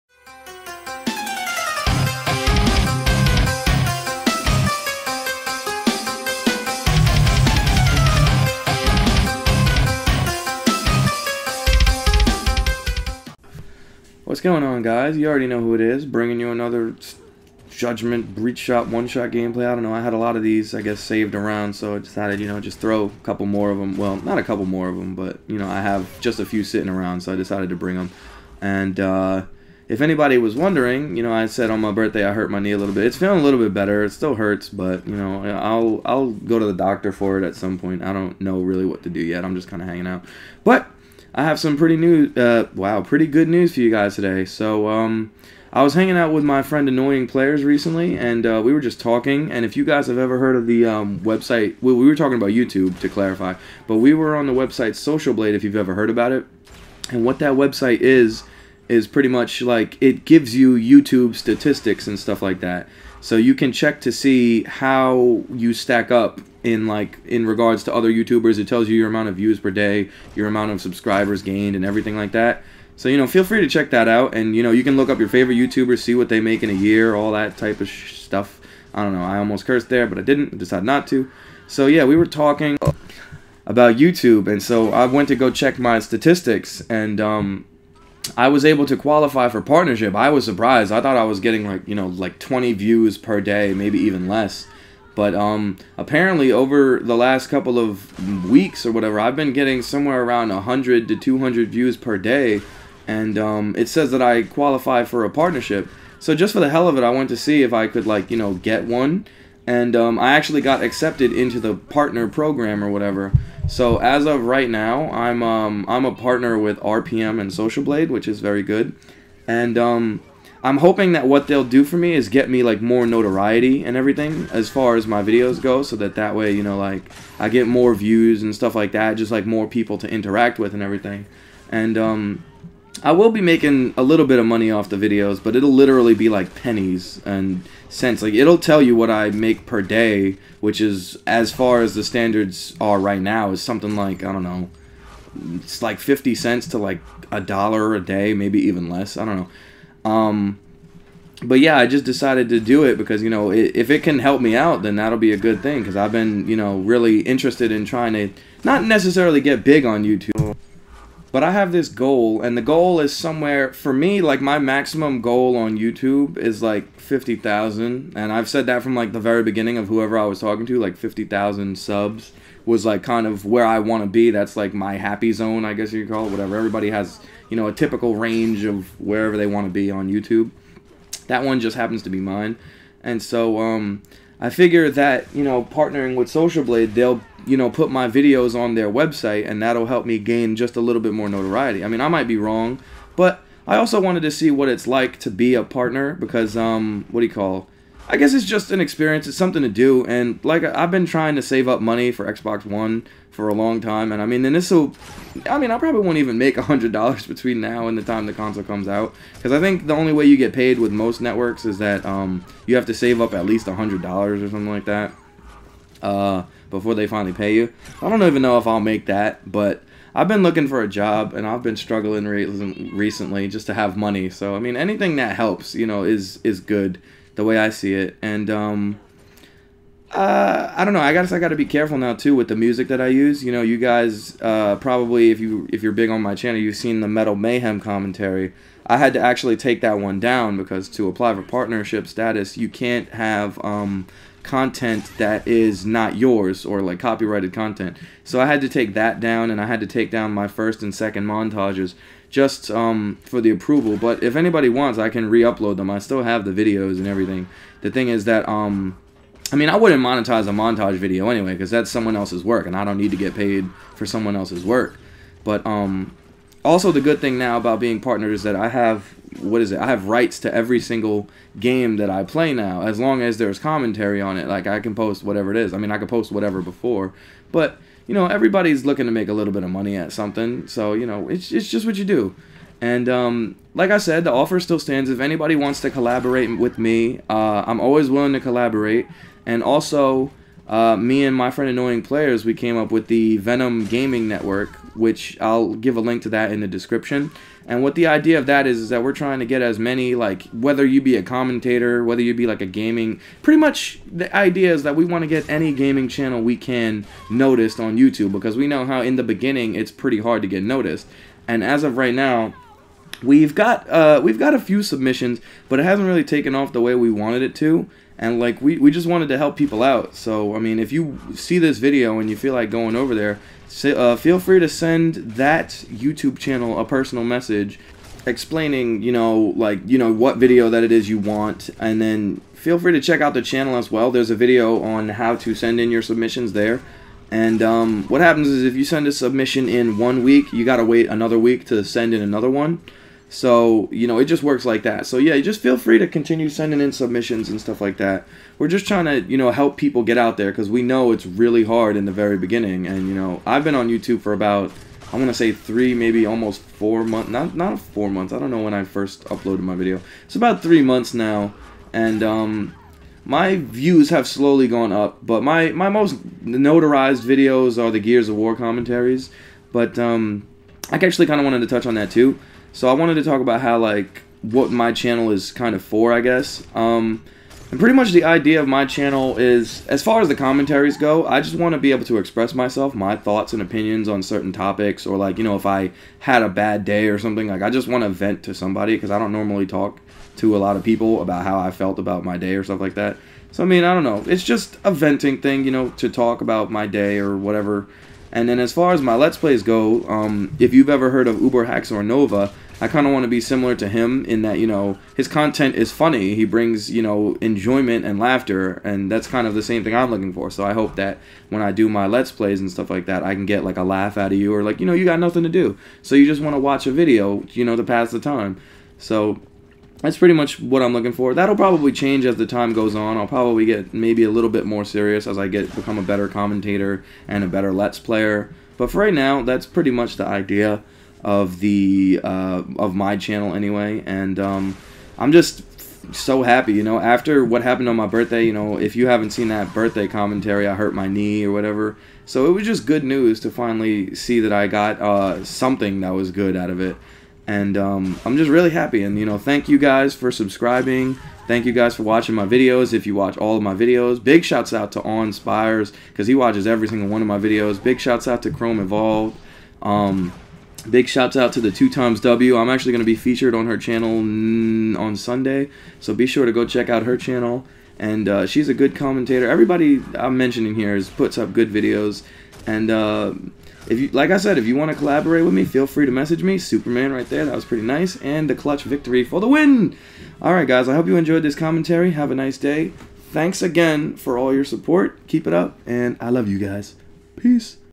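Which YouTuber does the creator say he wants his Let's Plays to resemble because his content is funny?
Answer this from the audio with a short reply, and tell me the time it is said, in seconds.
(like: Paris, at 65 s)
UberHaxorNova, at 401 s.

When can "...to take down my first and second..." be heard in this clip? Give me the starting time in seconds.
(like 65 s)
249 s.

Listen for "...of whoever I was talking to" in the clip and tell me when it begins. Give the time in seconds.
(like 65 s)
169 s.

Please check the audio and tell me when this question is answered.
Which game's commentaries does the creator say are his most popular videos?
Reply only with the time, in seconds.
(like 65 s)
367 s.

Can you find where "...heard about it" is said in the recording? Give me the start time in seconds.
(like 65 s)
55 s.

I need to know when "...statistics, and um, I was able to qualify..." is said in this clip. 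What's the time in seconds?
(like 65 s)
85 s.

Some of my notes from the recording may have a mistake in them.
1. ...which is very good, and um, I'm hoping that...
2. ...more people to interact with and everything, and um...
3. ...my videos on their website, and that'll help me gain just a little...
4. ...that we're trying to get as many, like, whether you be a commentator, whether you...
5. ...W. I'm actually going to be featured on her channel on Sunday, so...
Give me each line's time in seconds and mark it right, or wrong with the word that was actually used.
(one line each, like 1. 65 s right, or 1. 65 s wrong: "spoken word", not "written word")
1. 118 s right
2. 129 s right
3. 187 s right
4. 298 s right
5. 462 s right.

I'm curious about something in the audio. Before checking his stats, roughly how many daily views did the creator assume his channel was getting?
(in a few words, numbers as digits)
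20.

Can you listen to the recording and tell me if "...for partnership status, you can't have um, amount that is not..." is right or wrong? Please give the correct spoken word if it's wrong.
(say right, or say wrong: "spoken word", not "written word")
wrong: "content", not "amount".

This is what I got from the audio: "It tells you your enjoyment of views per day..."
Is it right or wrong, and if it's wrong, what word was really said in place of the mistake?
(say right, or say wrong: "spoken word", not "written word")
wrong: "amount", not "enjoyment".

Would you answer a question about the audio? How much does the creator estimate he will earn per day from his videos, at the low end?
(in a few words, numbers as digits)
50 cents.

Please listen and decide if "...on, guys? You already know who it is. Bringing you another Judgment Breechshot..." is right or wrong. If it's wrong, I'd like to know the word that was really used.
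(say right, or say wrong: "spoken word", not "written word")
right.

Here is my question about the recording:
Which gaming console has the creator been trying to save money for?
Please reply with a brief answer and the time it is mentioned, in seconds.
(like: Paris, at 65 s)
Xbox One, at 202 s.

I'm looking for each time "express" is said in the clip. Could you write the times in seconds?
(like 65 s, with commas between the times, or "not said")
382 s.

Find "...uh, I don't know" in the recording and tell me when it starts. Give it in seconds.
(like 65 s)
230 s.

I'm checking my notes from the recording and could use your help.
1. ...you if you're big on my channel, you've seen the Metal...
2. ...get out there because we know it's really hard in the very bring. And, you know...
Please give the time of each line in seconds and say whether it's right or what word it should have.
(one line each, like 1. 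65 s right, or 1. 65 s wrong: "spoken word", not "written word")
1. 235 s right
2. 350 s wrong: "beginning", not "bring".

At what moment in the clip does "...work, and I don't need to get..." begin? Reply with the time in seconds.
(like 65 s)
262 s.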